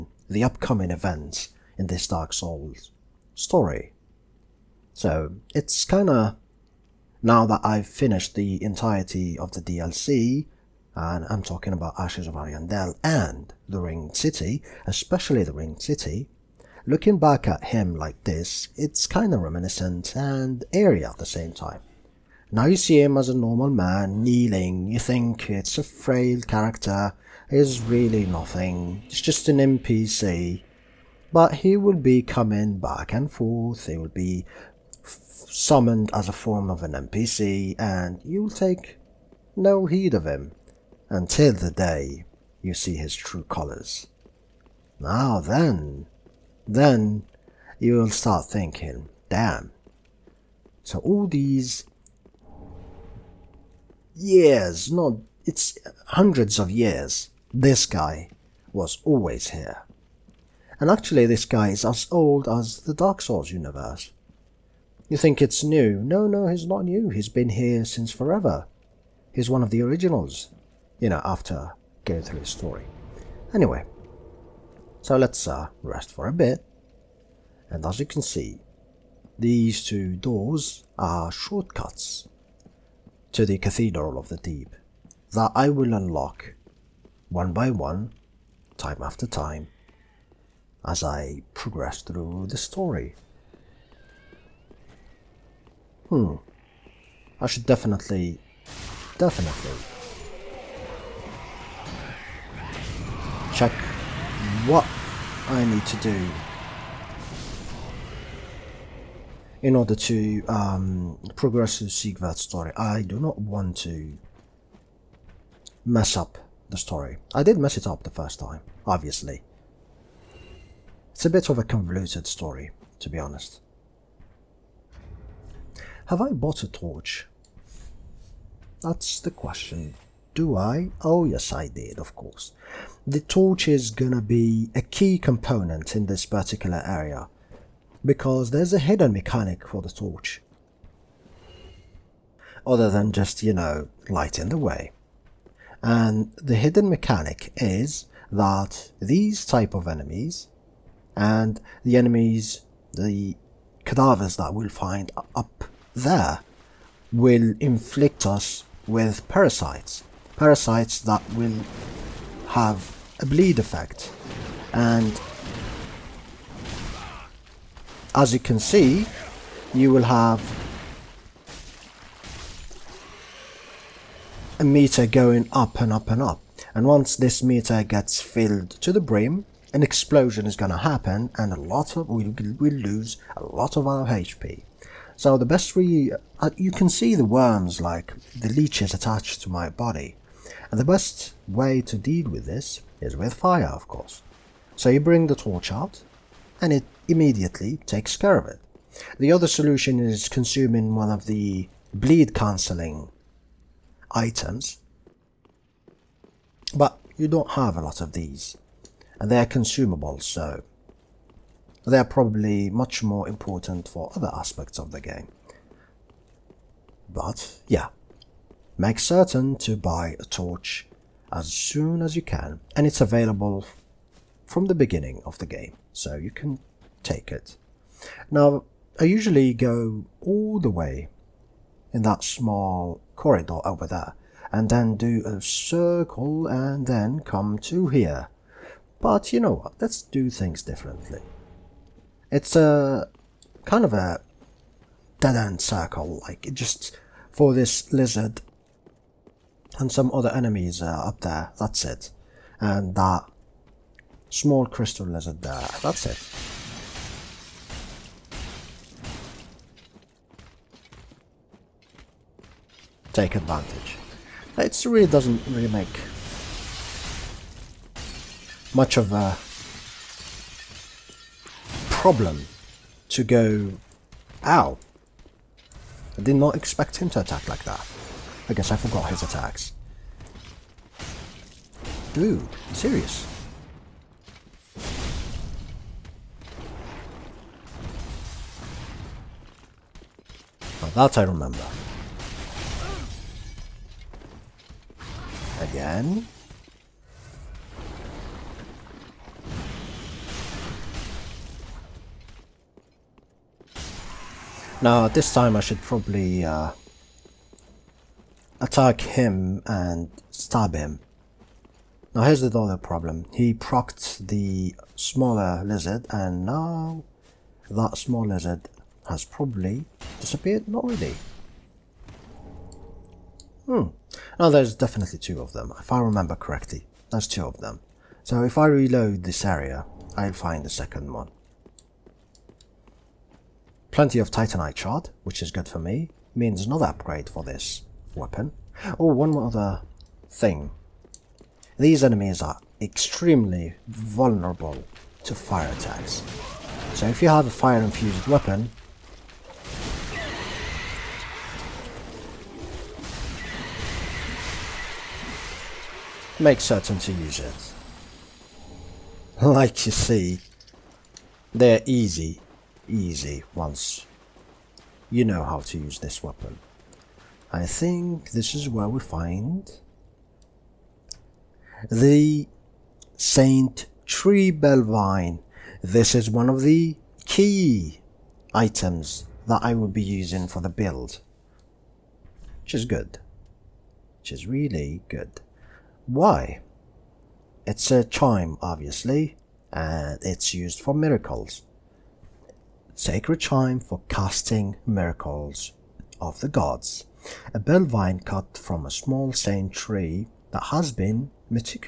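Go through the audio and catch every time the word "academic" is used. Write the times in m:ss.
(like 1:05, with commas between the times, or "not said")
not said.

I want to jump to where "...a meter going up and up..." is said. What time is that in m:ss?
2:54.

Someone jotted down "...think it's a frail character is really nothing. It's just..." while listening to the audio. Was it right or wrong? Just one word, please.
right.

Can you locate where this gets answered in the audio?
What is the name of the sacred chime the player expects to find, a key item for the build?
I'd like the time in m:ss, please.
6:13.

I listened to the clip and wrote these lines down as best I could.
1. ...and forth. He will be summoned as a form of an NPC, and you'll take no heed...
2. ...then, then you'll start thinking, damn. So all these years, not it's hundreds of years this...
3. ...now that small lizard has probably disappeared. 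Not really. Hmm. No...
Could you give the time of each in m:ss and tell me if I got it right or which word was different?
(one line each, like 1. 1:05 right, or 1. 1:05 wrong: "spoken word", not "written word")
1. 0:33 right
2. 0:45 right
3. 5:16 right.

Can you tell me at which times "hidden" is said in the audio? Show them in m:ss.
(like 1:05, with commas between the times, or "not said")
2:18, 2:26.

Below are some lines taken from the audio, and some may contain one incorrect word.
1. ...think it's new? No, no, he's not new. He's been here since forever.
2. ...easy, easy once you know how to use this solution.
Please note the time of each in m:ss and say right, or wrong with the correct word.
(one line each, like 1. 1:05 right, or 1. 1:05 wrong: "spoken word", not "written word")
1. 1:05 right
2. 6:01 wrong: "weapon", not "solution".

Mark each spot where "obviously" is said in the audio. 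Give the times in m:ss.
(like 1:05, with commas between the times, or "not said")
1:58, 6:28.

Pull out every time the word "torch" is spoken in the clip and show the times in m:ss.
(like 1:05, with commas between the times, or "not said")
2:06, 2:13, 2:19, 3:15, 3:40.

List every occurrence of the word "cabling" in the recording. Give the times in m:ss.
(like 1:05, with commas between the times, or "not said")
not said.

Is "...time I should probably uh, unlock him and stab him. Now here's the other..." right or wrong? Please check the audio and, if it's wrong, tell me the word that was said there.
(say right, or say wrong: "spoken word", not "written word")
wrong: "attack", not "unlock".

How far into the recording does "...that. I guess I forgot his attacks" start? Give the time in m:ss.
4:37.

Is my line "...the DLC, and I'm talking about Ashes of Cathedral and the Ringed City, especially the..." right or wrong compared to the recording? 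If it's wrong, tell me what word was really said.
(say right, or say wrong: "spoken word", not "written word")
wrong: "Ariandel", not "Cathedral".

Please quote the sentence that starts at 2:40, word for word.
Parasites that will have a bleed effect.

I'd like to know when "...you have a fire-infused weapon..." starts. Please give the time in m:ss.
5:47.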